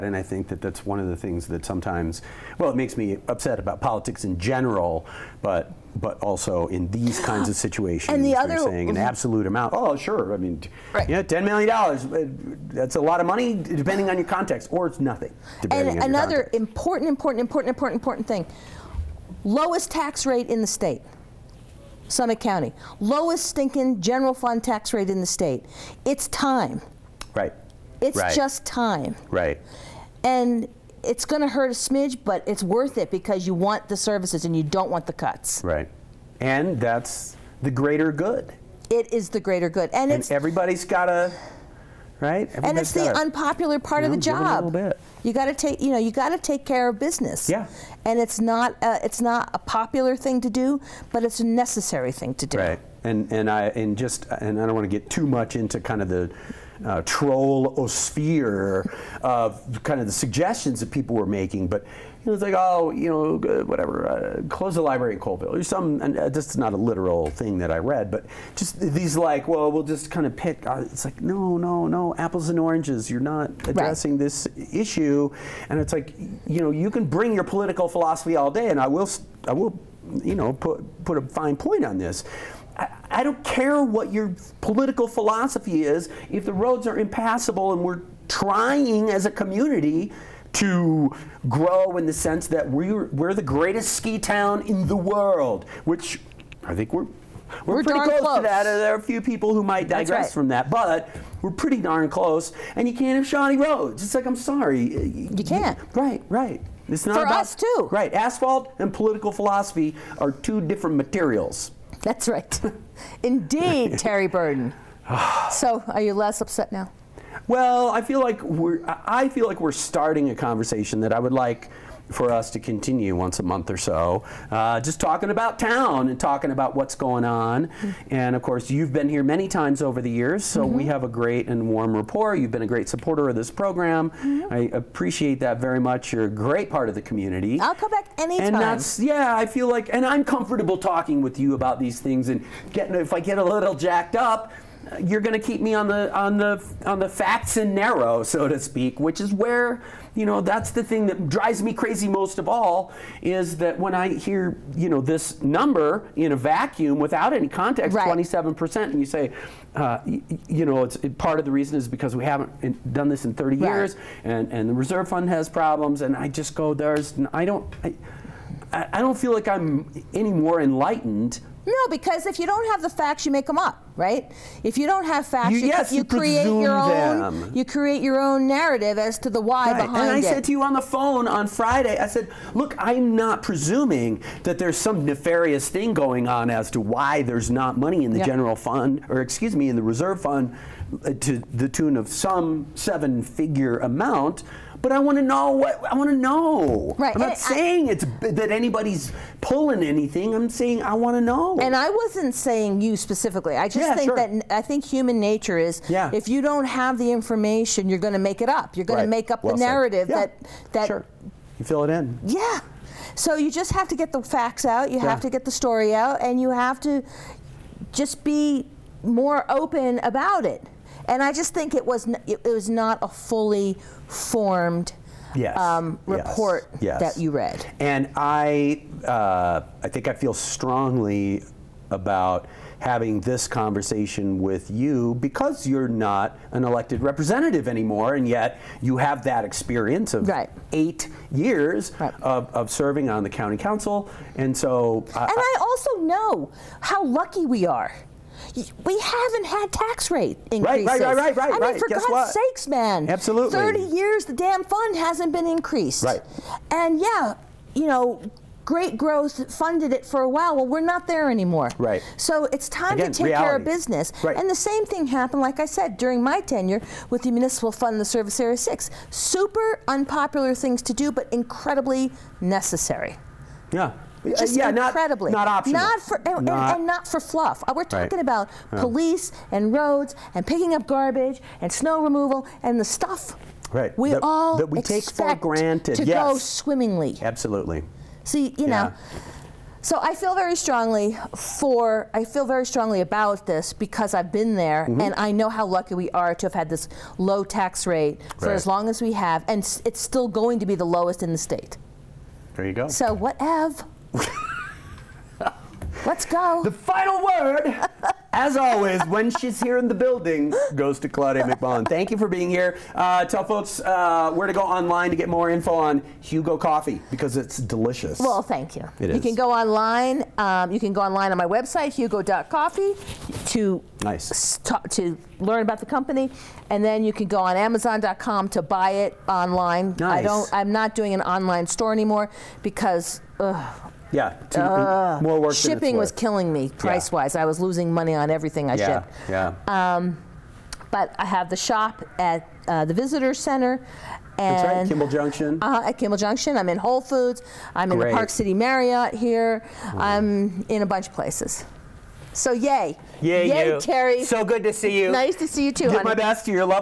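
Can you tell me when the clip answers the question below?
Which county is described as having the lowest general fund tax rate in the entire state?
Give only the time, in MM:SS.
00:22.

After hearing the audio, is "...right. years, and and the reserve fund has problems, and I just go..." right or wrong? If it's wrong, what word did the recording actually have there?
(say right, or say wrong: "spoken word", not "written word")
right.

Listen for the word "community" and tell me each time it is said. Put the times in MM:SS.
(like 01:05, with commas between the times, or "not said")
01:29, 02:17.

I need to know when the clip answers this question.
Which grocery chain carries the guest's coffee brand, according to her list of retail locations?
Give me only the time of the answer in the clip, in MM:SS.
05:46.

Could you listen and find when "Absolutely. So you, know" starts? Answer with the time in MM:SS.
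04:47.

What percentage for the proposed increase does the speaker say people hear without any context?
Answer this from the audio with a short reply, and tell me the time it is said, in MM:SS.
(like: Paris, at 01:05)
27%, at 02:38.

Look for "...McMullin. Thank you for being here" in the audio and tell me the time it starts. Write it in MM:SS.
05:11.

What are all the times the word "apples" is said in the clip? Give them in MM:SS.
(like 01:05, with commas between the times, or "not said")
01:12.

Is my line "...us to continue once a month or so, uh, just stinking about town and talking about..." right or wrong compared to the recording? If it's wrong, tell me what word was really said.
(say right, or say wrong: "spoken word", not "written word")
wrong: "talking", not "stinking".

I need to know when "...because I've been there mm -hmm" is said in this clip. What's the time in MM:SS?
04:53.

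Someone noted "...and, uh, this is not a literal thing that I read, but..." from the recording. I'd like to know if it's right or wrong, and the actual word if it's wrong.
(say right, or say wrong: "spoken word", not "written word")
right.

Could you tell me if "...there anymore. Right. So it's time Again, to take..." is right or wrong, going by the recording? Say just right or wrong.
right.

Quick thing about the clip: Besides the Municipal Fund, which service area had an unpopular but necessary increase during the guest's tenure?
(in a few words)
Service Area 6.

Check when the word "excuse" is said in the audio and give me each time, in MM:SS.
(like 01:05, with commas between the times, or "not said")
03:09.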